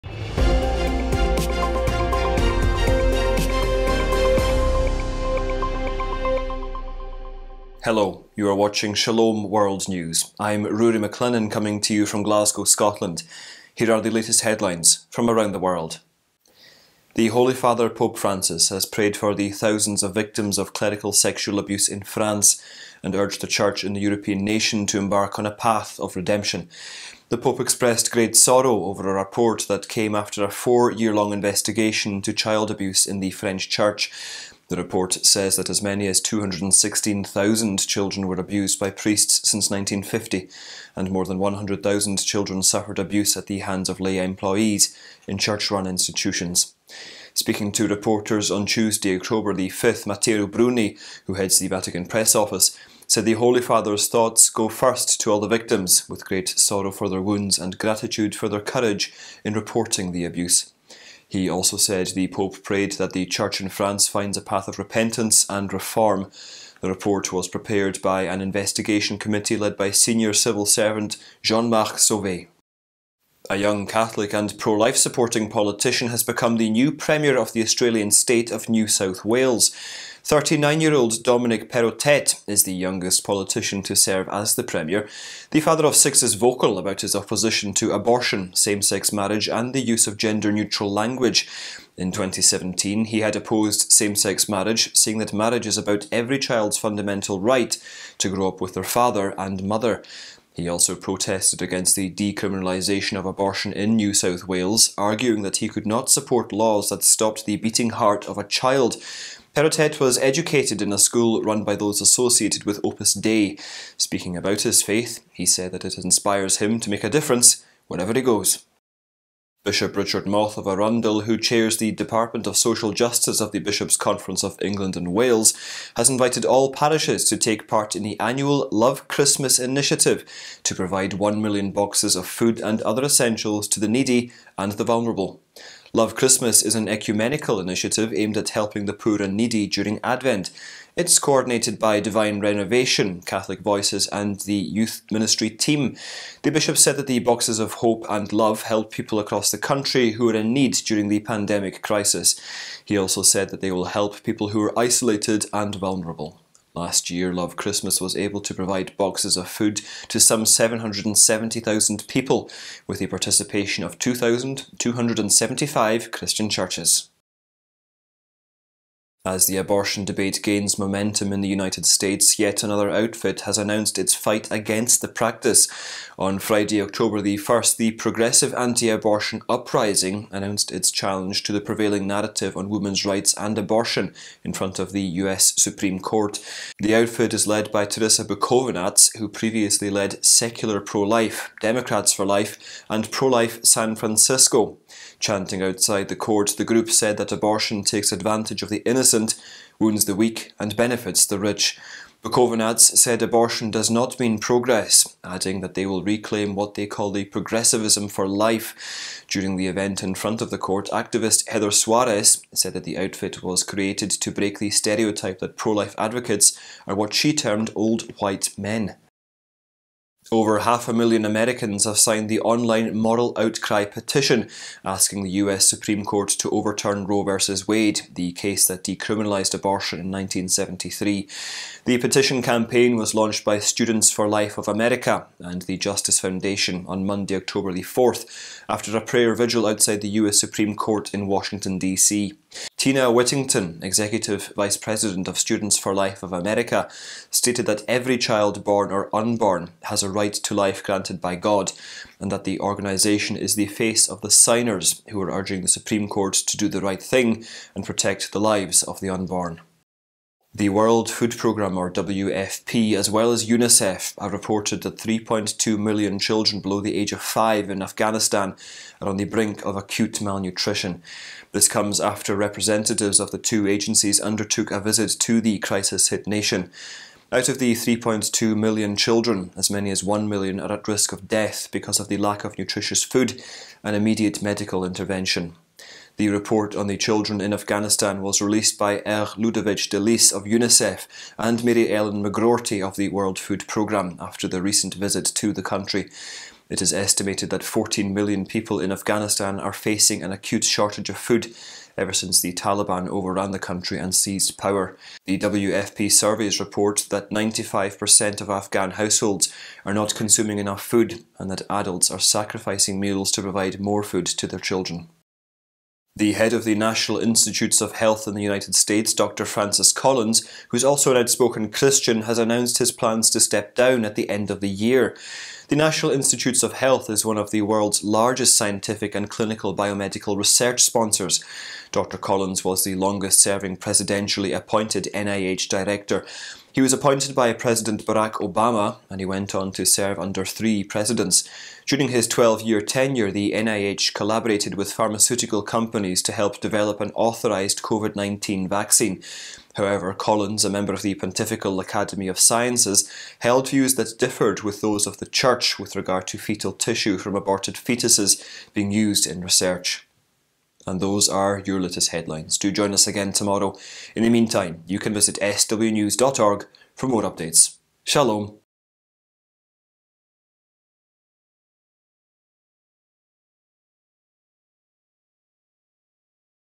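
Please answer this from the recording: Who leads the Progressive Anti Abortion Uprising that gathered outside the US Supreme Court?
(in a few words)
Teresa Bukovinac.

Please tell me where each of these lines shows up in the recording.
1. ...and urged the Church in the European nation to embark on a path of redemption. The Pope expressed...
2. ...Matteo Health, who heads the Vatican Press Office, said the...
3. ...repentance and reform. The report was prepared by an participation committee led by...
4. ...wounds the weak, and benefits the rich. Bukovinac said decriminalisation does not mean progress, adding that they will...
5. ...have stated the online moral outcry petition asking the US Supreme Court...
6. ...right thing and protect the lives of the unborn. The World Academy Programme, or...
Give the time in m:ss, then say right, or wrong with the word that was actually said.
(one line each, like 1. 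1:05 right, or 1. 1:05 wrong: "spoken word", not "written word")
1. 0:23 right
2. 0:50 wrong: "Bruni", not "Health"
3. 1:04 wrong: "investigation", not "participation"
4. 3:19 wrong: "abortion", not "decriminalisation"
5. 3:41 wrong: "signed", not "stated"
6. 4:16 wrong: "Food", not "Academy".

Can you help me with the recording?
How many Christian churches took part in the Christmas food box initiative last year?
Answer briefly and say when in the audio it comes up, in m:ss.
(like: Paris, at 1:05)
2,275, at 2:43.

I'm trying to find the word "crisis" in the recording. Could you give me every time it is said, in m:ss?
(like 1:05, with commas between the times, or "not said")
2:31, 4:35.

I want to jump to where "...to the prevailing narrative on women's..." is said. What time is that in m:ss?
3:01.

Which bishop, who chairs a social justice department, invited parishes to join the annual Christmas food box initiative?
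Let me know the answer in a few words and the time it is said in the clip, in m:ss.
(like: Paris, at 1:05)
Richard Moth, at 1:59.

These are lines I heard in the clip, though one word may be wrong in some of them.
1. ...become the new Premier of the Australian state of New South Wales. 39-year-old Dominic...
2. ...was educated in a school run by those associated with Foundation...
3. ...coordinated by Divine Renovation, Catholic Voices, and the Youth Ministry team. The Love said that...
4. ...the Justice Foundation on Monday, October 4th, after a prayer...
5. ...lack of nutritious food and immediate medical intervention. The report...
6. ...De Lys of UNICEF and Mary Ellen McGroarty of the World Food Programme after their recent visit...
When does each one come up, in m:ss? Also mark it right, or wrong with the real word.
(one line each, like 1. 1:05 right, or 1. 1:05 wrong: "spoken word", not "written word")
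1. 1:16 right
2. 1:50 wrong: "Opus", not "Foundation"
3. 2:21 wrong: "Bishop", not "Love"
4. 3:55 right
5. 4:42 right
6. 4:49 right.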